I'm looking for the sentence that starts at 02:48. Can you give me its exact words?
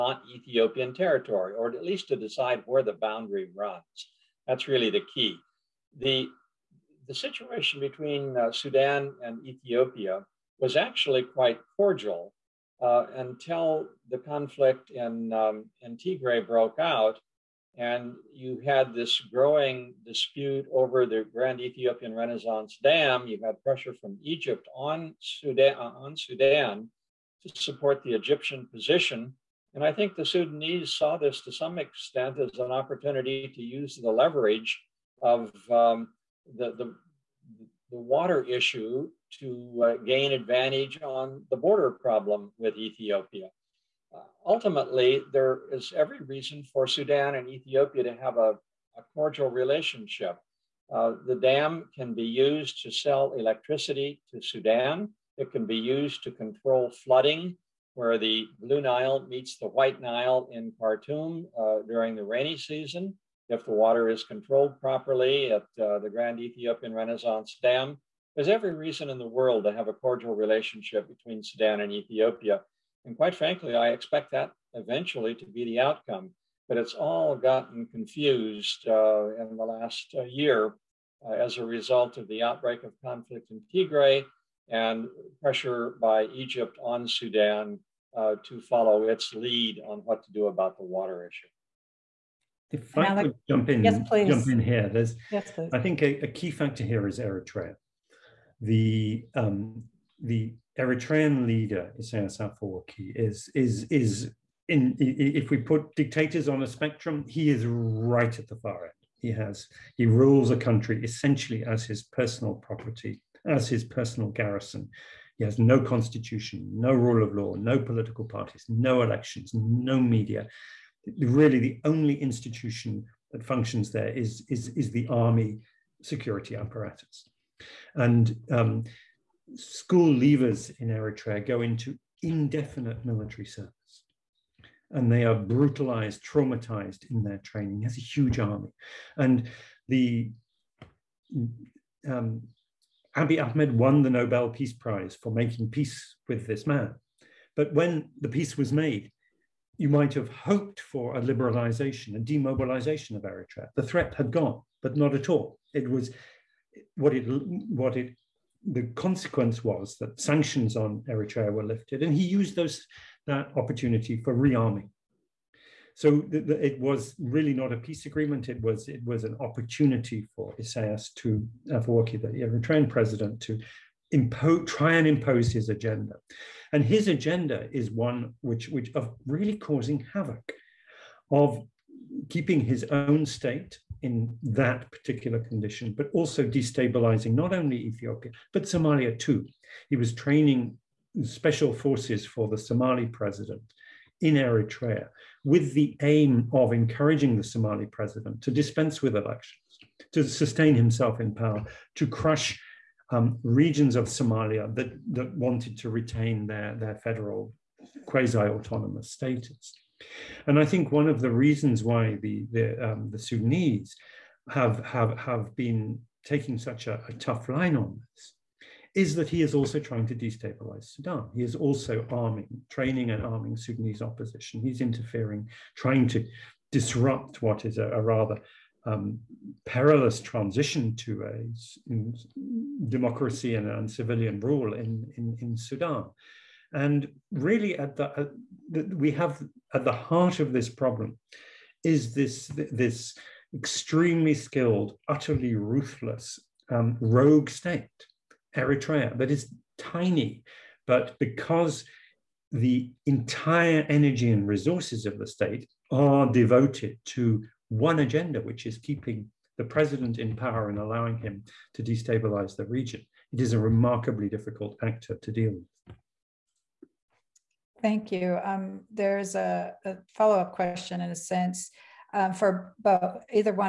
It was it was an opportunity for Isaias to uh, Afwerki, the Eritrean president, to try and impose his agenda.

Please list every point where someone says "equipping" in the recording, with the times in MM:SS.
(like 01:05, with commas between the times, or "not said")
not said.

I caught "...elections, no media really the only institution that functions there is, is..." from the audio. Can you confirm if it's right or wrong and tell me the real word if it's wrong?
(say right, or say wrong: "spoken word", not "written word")
right.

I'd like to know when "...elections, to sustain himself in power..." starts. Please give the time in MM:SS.
03:19.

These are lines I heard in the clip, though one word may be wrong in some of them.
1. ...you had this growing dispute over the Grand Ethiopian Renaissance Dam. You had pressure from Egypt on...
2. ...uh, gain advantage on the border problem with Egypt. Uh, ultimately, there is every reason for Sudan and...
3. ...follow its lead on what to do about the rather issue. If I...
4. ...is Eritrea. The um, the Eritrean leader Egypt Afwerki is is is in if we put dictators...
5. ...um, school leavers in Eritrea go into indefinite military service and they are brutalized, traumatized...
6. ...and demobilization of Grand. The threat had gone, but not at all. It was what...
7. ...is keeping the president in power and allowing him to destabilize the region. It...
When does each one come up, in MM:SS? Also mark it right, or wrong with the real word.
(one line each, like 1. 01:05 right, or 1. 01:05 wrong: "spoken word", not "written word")
1. 00:18 right
2. 00:39 wrong: "Ethiopia", not "Egypt"
3. 01:28 wrong: "water", not "rather"
4. 01:37 wrong: "Isaias", not "Egypt"
5. 02:08 right
6. 02:32 wrong: "Eritrea", not "Grand"
7. 04:18 right.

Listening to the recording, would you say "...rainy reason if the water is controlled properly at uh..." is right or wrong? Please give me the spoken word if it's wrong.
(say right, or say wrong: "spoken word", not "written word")
wrong: "season", not "reason".